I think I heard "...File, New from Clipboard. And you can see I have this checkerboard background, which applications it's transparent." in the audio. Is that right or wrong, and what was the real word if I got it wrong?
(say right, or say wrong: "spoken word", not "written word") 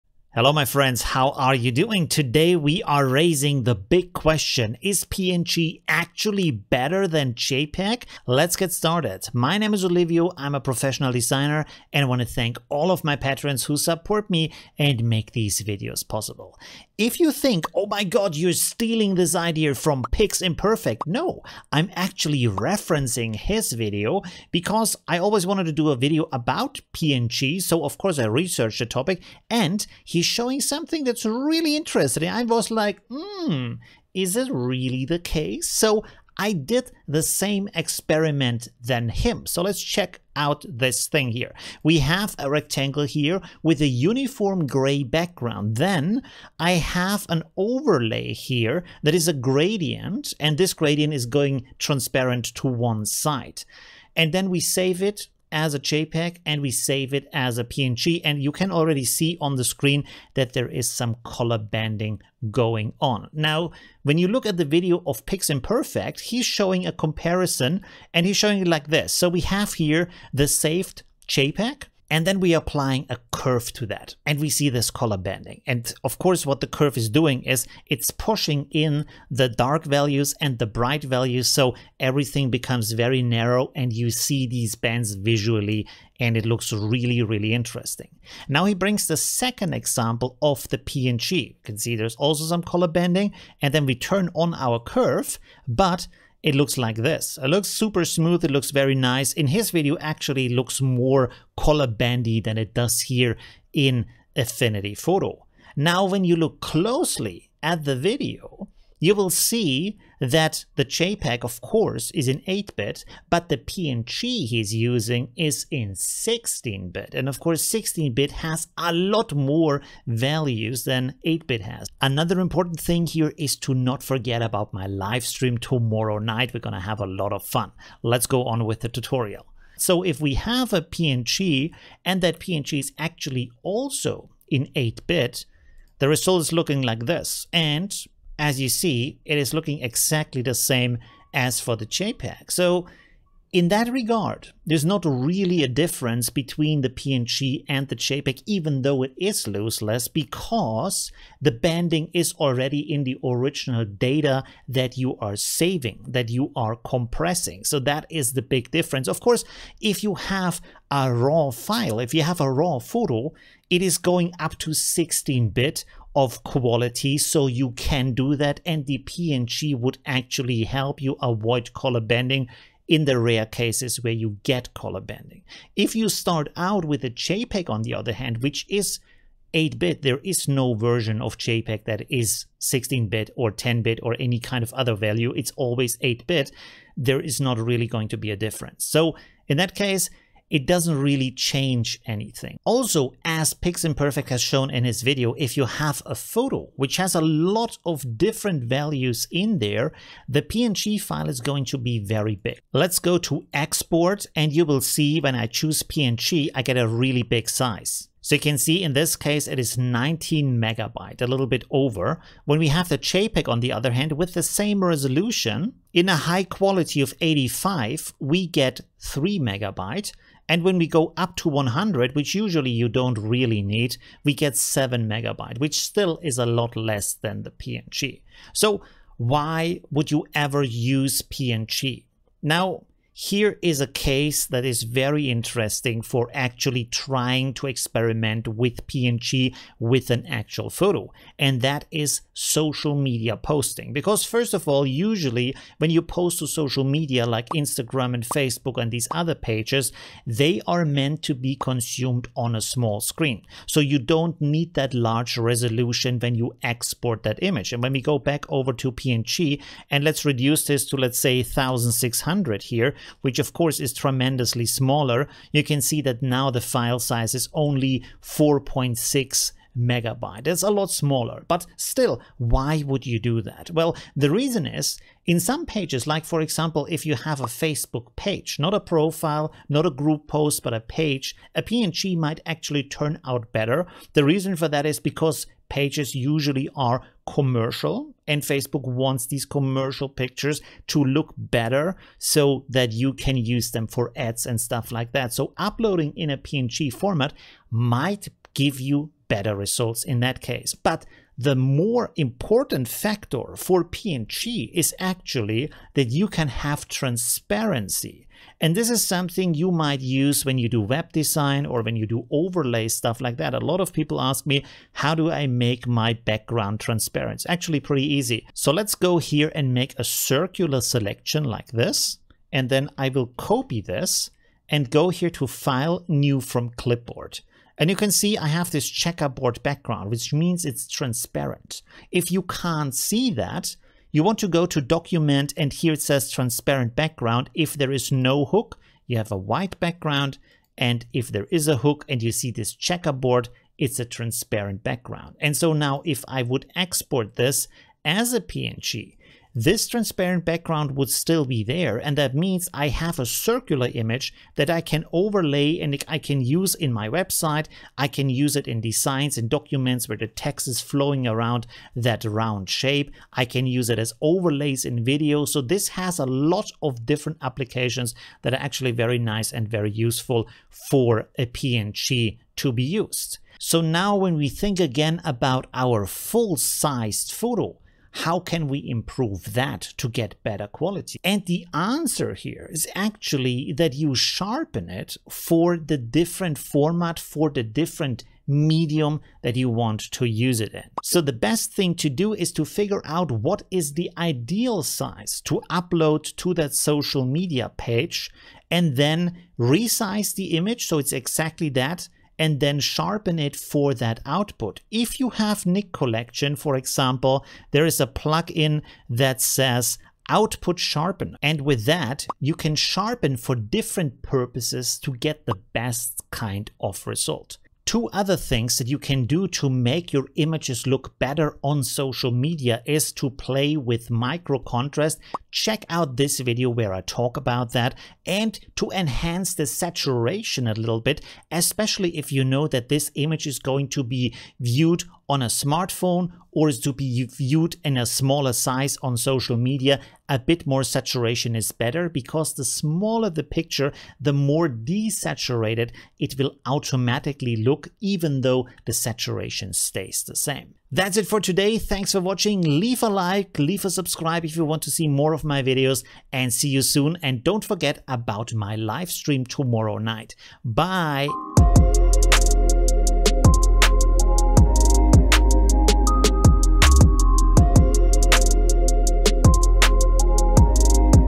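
wrong: "means", not "applications".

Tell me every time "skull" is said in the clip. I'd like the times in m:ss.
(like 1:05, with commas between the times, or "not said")
not said.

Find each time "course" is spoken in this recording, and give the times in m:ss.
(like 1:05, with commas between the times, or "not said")
0:27, 1:16, 1:51, 1:57, 2:39, 4:23.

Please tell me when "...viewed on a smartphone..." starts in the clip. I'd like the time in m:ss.
7:14.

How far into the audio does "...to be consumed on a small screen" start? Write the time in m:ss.
4:11.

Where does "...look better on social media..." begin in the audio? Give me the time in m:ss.
7:00.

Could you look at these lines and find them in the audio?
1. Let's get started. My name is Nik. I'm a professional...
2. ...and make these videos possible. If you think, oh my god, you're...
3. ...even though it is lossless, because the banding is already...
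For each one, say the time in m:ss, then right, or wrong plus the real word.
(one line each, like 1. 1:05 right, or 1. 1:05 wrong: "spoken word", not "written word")
1. 0:08 wrong: "Olivio", not "Nik"
2. 0:14 right
3. 2:28 right.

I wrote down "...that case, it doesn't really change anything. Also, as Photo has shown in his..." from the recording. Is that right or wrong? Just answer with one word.
wrong.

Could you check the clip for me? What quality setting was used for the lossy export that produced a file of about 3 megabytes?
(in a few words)
85.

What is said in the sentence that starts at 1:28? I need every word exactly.
Now he brings the second example of the PNG.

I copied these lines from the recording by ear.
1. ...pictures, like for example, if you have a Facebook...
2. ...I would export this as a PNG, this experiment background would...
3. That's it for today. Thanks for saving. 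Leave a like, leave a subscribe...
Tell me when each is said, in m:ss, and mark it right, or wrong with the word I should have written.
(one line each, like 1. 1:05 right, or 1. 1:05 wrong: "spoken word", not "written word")
1. 4:35 wrong: "pages", not "pictures"
2. 5:46 wrong: "transparent", not "experiment"
3. 7:30 wrong: "watching", not "saving".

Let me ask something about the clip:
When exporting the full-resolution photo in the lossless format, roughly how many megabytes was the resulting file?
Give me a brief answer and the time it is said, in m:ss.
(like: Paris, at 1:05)
19 megabytes, at 3:29.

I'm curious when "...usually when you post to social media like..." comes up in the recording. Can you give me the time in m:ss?
4:04.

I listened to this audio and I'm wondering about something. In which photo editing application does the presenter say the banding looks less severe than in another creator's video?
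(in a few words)
Affinity Photo.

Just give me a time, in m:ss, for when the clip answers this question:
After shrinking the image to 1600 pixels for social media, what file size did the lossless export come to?
4:28.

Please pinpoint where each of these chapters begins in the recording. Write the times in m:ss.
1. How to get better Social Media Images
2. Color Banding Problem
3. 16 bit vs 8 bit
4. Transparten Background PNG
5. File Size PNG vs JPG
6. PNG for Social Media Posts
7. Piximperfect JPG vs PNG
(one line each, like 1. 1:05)
1. 6:13
2. 0:39
3. 1:45
4. 5:18
5. 3:15
6. 3:53
7. 0:17.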